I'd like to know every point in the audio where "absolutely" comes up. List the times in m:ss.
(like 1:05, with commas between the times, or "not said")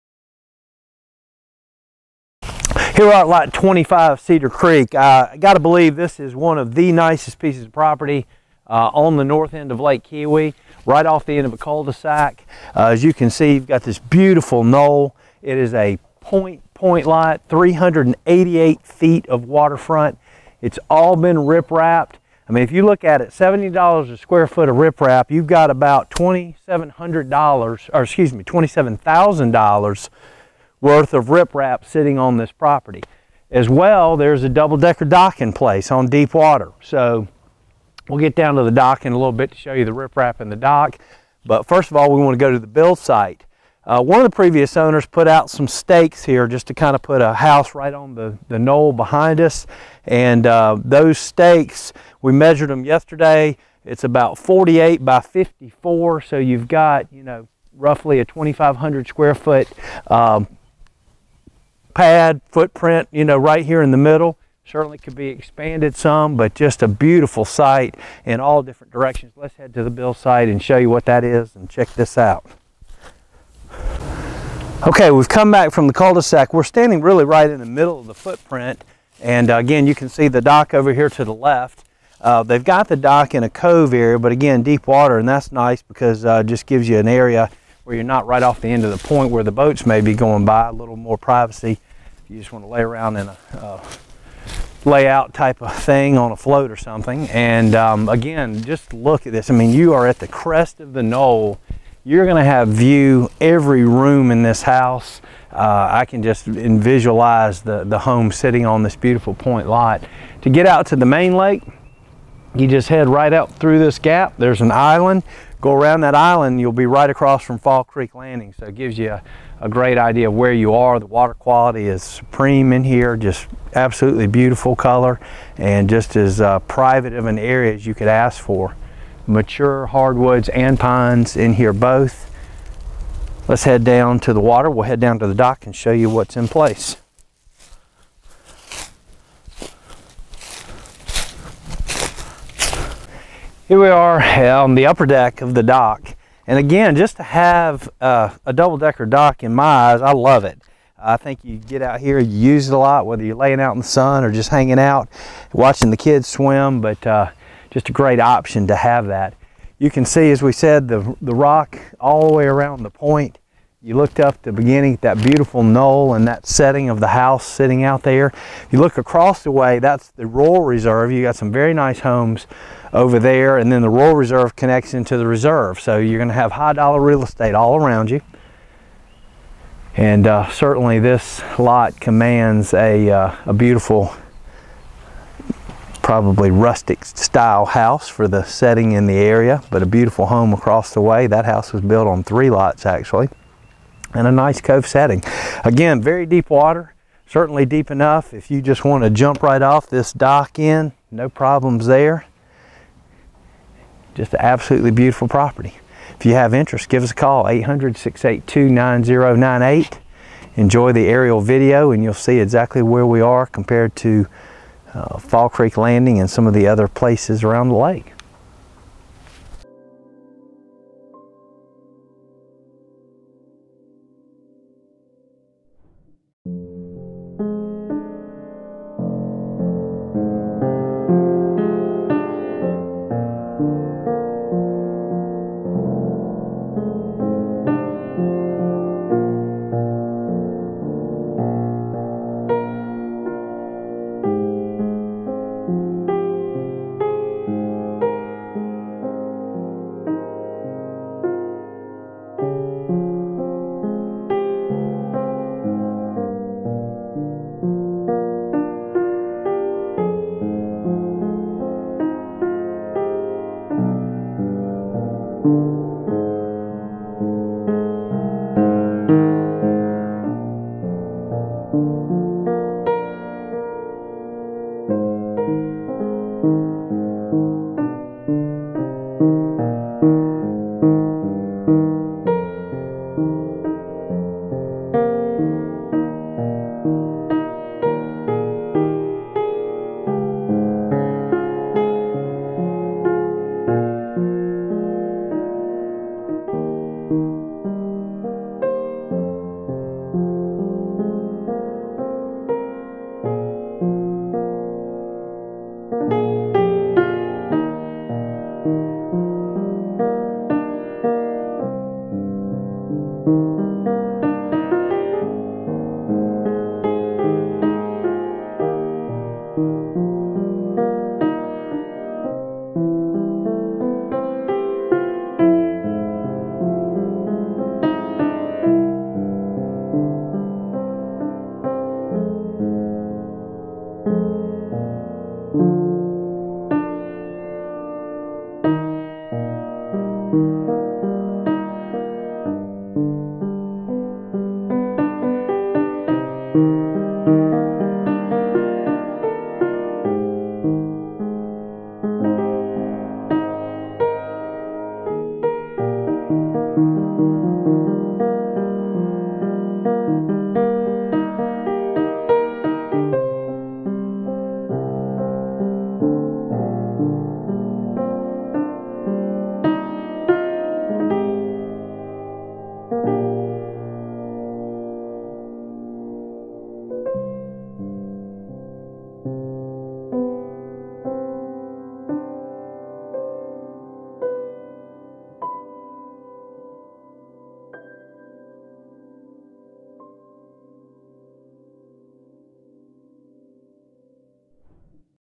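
2:03, 3:24.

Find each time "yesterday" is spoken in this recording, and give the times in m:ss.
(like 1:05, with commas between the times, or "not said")
0:52.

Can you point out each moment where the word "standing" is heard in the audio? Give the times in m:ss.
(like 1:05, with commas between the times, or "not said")
1:16.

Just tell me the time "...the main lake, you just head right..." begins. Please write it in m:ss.
1:50.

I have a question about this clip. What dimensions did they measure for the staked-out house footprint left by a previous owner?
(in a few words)
48 by 54.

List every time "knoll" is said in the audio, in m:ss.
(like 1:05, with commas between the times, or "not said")
0:14, 0:48, 1:41, 2:45.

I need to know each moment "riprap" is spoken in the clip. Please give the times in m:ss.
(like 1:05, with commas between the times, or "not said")
0:24, 0:31, 0:39.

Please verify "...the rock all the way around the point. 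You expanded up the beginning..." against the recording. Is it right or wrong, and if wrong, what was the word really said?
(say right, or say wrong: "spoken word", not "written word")
wrong: "looked", not "expanded".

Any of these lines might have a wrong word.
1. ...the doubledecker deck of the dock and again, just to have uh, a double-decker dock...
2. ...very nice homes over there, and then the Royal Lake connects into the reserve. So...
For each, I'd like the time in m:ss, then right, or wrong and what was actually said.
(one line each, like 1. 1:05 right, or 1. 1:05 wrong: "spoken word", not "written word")
1. 2:24 wrong: "upper", not "doubledecker"
2. 2:51 wrong: "Reserve", not "Lake".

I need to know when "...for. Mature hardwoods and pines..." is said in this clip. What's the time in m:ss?
2:08.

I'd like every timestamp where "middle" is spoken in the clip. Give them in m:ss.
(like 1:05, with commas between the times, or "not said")
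1:03, 1:17.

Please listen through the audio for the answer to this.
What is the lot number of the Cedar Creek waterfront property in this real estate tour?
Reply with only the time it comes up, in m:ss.
0:03.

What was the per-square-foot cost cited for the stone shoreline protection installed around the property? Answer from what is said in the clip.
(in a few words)
$70.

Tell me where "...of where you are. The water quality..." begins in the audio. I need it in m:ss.
2:00.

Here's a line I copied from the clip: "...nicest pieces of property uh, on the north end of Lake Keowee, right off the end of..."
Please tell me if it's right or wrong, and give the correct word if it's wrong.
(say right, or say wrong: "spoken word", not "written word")
right.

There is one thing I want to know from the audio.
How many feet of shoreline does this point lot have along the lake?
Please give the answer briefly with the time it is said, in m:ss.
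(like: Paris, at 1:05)
388 feet, at 0:17.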